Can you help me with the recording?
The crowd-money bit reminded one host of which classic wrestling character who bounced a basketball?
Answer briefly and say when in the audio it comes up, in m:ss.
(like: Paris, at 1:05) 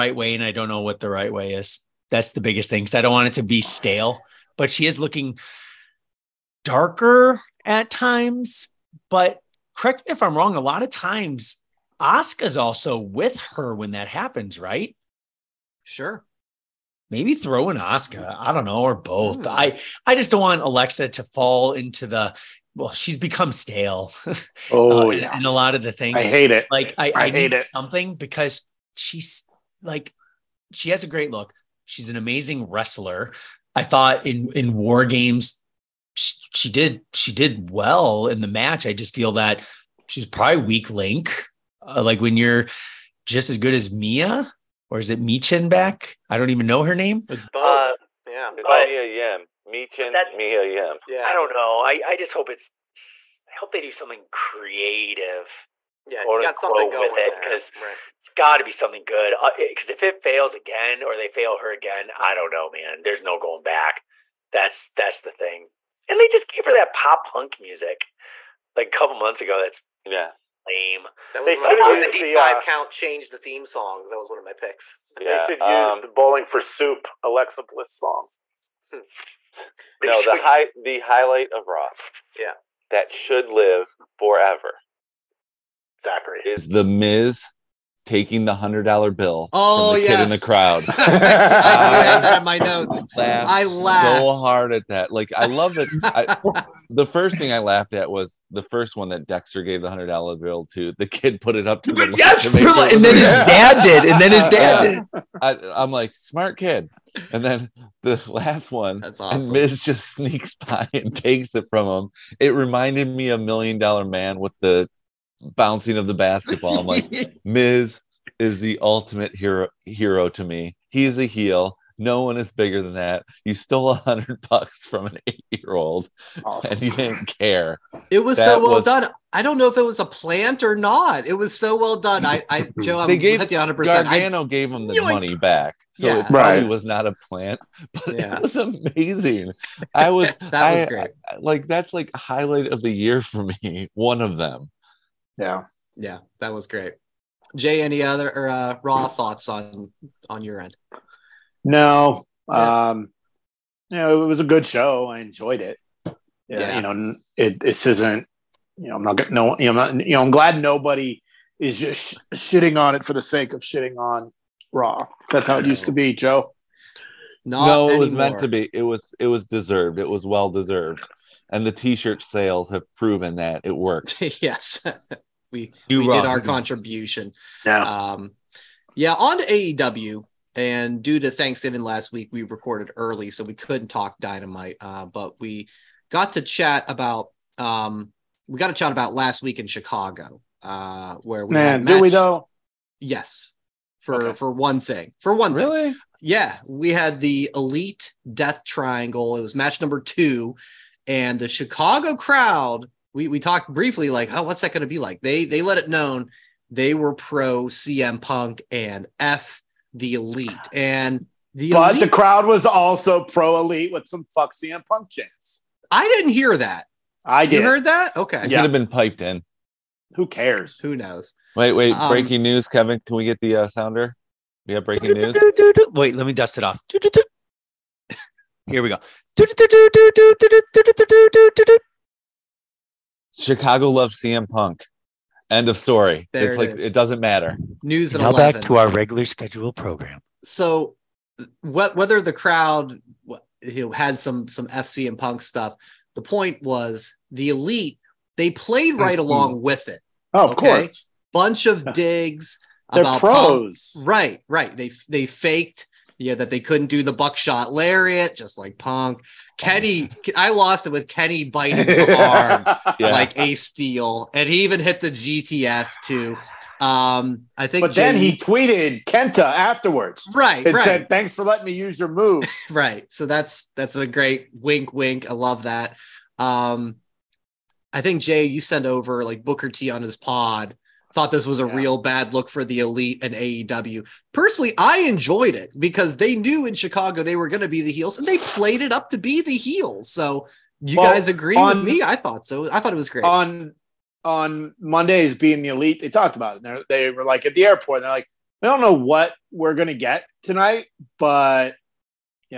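Million Dollar Man, at 1:53.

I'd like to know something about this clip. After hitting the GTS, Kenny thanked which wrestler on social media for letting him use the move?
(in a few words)
Kenta.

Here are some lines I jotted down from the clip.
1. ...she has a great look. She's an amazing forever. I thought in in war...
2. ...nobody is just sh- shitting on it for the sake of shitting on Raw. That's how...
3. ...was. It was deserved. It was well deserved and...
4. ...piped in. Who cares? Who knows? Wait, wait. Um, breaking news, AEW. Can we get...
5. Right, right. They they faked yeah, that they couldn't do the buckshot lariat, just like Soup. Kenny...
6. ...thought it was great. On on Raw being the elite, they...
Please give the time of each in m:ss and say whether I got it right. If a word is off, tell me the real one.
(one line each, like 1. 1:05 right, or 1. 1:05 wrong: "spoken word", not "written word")
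1. 0:30 wrong: "wrestler", not "forever"
2. 2:40 right
3. 2:48 right
4. 3:38 wrong: "Kevin", not "AEW"
5. 4:14 wrong: "Punk", not "Soup"
6. 4:52 wrong: "Mondays", not "Raw".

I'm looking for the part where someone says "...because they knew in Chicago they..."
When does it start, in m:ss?
4:45.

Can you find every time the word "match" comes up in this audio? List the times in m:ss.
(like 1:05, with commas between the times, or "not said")
0:38, 3:11, 3:19.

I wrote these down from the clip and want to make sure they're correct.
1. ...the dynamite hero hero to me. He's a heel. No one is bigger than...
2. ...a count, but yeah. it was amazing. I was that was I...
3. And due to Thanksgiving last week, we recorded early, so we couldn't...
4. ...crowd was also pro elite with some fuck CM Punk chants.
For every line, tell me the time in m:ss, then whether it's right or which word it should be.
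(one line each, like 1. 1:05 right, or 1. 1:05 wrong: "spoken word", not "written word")
1. 1:58 wrong: "ultimate", not "dynamite"
2. 2:17 wrong: "plant", not "count"
3. 3:00 right
4. 3:32 right.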